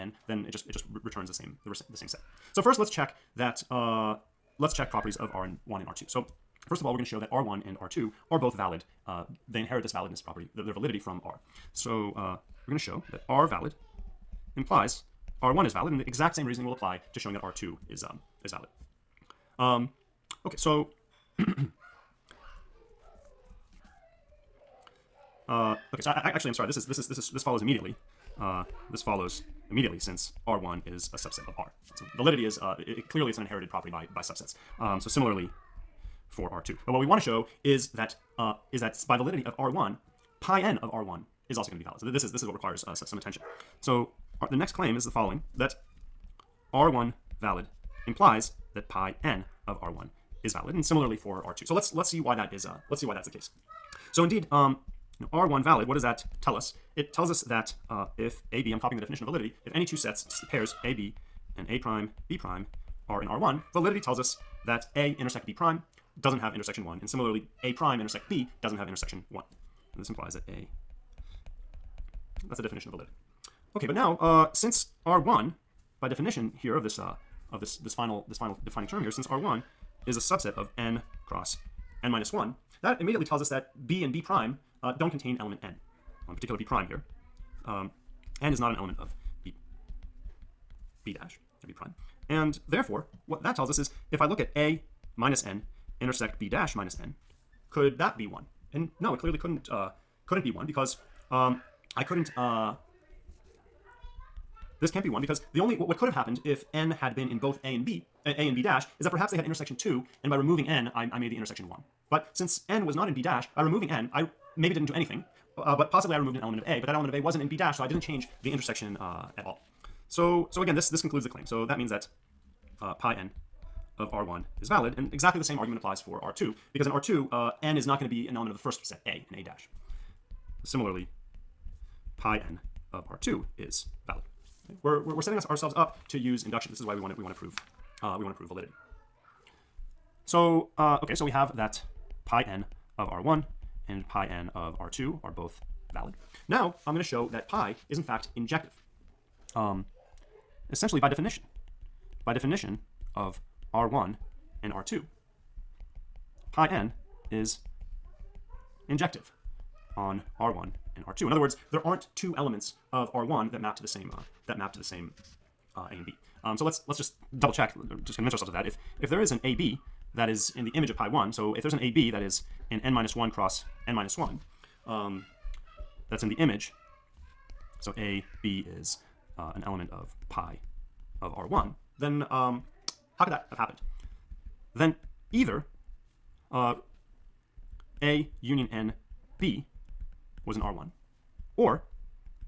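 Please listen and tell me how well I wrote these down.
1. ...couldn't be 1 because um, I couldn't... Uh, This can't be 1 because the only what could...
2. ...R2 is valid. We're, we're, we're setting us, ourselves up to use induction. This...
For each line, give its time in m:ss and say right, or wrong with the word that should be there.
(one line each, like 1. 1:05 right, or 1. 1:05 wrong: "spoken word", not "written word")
1. 1:40 right
2. 2:13 right.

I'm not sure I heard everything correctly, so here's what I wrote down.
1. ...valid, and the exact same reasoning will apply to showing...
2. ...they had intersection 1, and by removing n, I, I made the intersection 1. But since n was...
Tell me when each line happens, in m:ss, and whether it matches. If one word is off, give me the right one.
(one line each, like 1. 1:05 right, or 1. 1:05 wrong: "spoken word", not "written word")
1. 0:15 right
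2. 1:49 wrong: "2", not "1".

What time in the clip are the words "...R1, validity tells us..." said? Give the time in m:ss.
1:03.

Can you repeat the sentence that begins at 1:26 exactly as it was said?
Well, in particular, b prime here.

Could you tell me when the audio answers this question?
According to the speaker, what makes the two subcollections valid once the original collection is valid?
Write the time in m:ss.
0:30.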